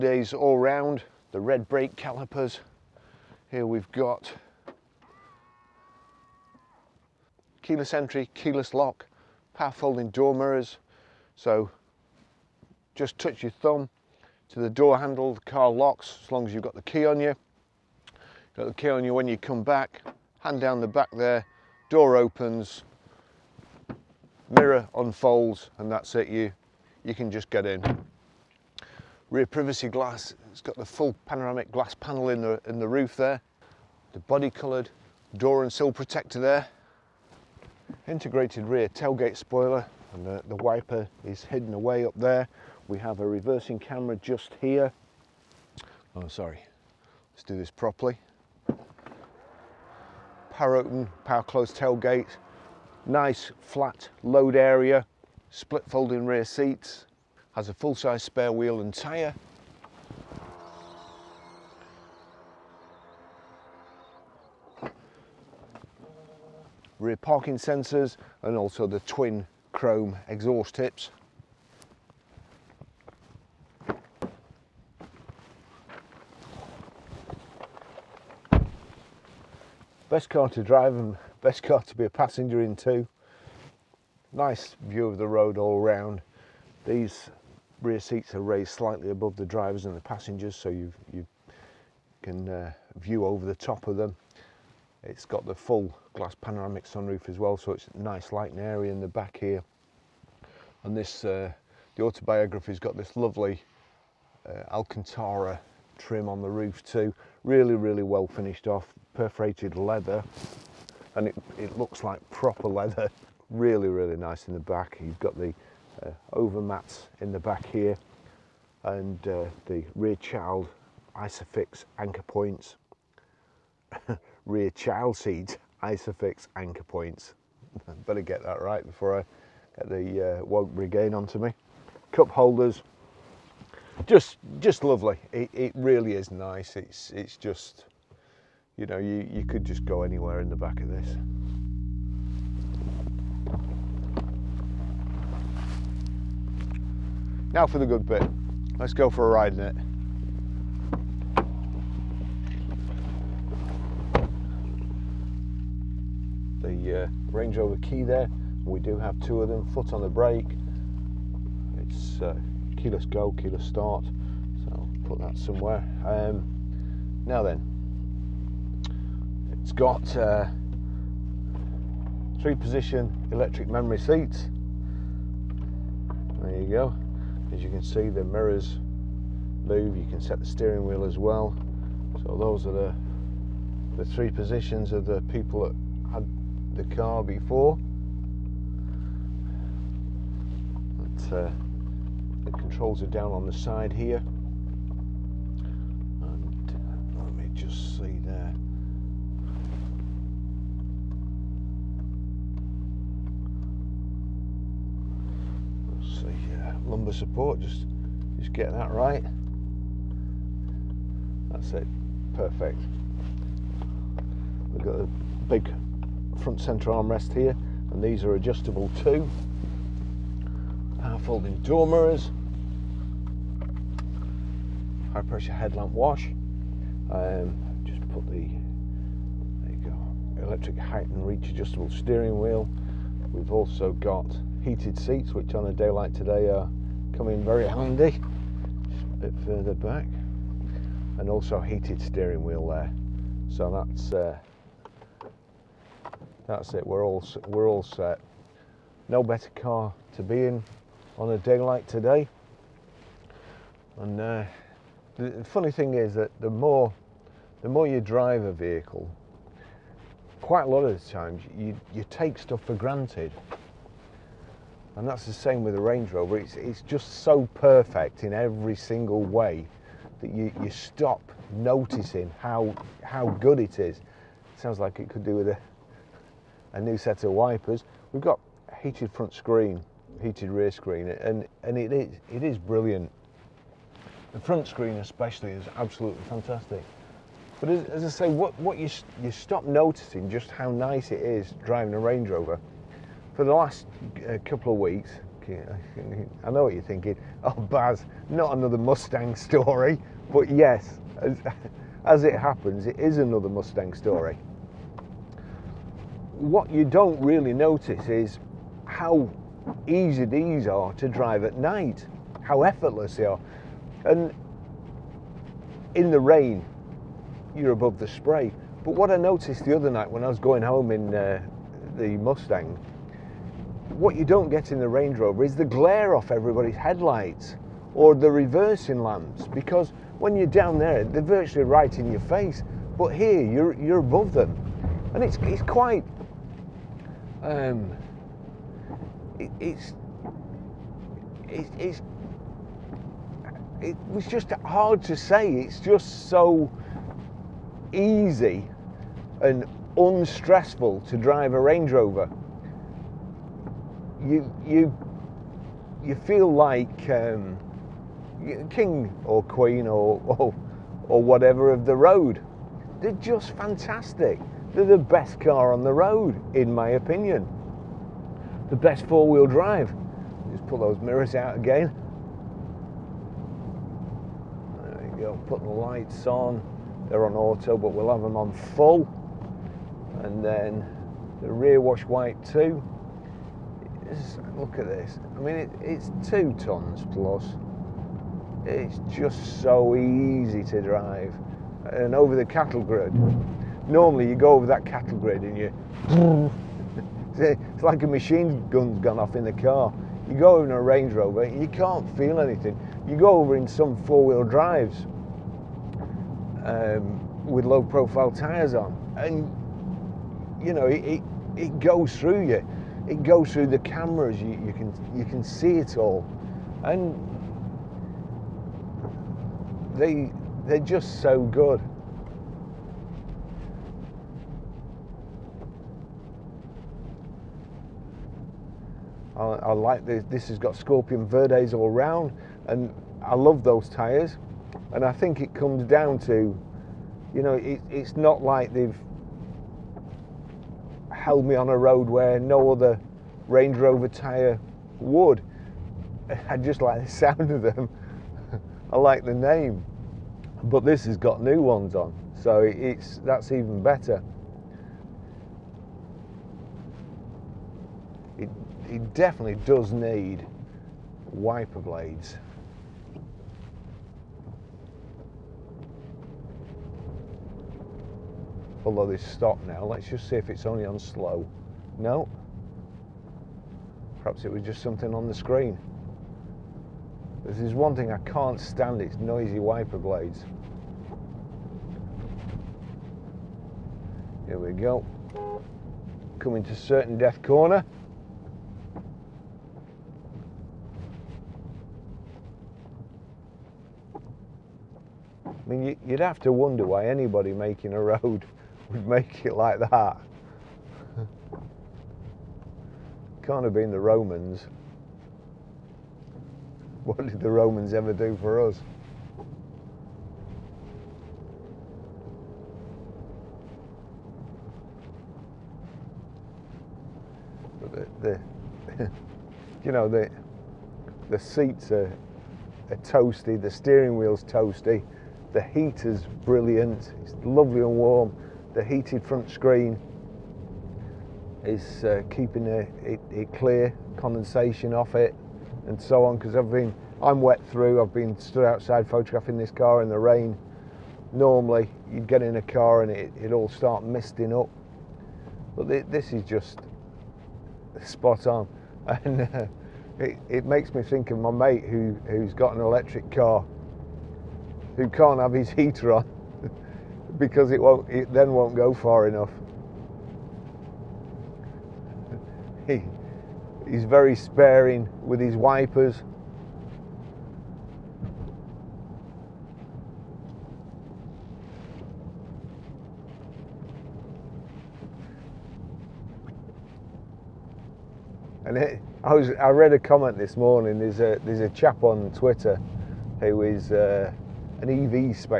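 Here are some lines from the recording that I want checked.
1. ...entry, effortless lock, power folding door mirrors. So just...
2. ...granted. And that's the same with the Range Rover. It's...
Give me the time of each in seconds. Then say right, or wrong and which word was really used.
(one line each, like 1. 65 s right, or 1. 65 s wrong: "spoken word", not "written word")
1. 7 s wrong: "keyless", not "effortless"
2. 262 s right.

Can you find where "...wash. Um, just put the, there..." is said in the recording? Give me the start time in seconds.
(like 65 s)
225 s.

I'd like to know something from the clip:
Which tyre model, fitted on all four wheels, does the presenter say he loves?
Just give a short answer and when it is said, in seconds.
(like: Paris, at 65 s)
Scorpion Verdes, at 430 s.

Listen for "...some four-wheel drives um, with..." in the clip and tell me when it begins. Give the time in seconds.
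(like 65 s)
403 s.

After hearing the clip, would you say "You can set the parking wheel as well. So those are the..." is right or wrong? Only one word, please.
wrong.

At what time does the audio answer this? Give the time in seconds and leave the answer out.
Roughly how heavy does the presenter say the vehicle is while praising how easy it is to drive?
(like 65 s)
386 s.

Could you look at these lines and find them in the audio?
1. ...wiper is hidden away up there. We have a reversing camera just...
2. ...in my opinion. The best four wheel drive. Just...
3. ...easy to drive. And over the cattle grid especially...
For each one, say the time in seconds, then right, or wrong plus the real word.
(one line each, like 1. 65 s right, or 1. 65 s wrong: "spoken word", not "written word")
1. 40 s right
2. 366 s right
3. 389 s wrong: "normally", not "especially".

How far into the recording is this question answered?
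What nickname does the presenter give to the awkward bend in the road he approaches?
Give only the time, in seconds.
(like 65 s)
486 s.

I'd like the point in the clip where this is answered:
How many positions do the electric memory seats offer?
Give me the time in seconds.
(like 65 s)
172 s.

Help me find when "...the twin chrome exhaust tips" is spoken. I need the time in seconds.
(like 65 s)
68 s.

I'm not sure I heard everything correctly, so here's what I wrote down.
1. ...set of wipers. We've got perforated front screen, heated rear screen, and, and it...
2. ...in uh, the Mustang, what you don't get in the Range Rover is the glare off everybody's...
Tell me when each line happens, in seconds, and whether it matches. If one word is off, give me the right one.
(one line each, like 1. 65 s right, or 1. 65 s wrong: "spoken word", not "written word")
1. 276 s wrong: "heated", not "perforated"
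2. 320 s right.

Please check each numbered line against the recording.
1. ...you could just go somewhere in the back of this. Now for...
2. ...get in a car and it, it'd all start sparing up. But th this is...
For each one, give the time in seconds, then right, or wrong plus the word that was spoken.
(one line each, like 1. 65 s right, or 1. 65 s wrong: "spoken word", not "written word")
1. 139 s wrong: "anywhere", not "somewhere"
2. 542 s wrong: "misting", not "sparing".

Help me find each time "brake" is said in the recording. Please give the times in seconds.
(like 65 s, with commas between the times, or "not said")
1 s, 160 s.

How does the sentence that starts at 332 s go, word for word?
But here, you're, you're above them.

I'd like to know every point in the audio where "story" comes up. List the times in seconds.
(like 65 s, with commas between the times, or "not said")
299 s, 303 s.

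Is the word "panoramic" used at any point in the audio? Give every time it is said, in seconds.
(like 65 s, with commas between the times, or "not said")
31 s, 96 s.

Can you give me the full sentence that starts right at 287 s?
But as, as I say, what, what you, you stop noticing just how nice it is driving a Range Rover.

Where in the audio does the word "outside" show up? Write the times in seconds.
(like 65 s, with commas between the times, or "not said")
538 s.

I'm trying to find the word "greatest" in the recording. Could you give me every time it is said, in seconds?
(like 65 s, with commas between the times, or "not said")
not said.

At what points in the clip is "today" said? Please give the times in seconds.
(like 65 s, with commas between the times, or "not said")
236 s, 251 s.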